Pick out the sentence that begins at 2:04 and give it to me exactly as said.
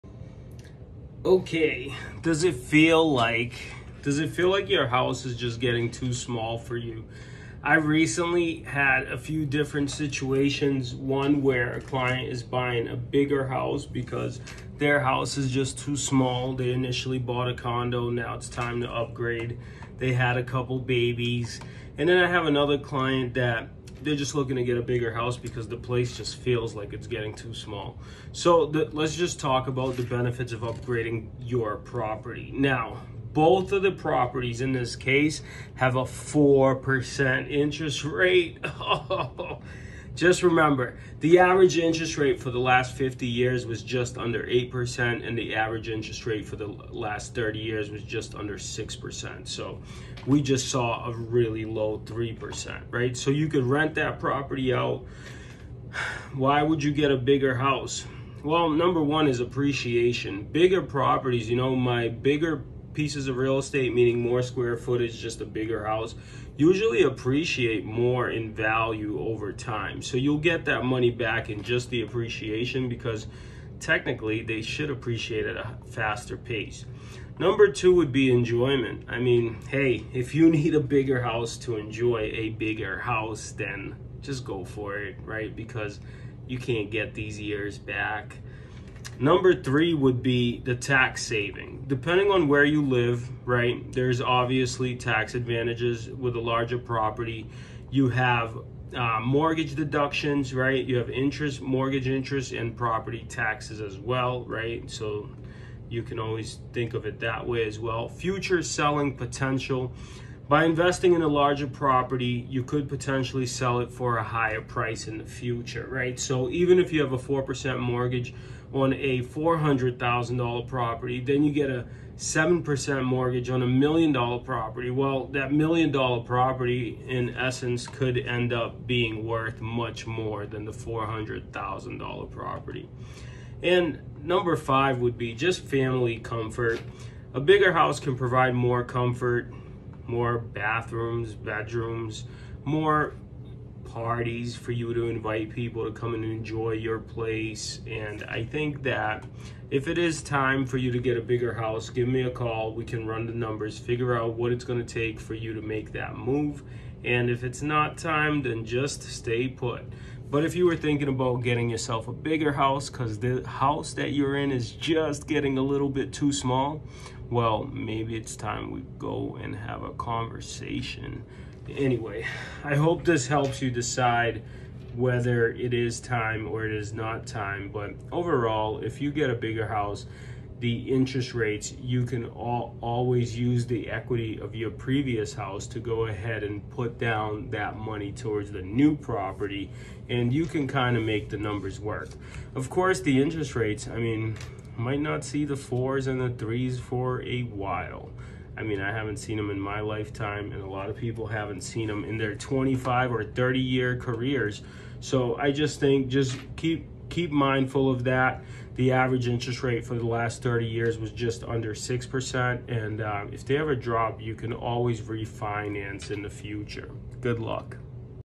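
Well, that million dollar property in essence could end up being worth much more than the $400,000 property.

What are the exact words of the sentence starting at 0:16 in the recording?
They initially bought a condo, now it's time to upgrade.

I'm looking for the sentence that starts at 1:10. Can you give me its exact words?
So you'll get that money back in just the appreciation because technically they should appreciate at a faster pace.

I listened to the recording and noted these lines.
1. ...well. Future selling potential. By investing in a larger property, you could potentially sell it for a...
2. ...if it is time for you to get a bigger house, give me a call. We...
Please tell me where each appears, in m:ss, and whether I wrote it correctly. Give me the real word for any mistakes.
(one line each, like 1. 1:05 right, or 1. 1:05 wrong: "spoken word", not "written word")
1. 1:47 right
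2. 2:29 right.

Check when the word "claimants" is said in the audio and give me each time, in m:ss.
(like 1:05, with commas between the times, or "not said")
not said.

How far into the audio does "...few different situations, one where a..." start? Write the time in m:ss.
0:09.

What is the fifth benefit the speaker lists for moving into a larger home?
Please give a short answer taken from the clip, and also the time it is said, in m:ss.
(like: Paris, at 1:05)
family comfort, at 2:15.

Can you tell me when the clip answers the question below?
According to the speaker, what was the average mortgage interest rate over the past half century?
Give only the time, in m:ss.
0:43.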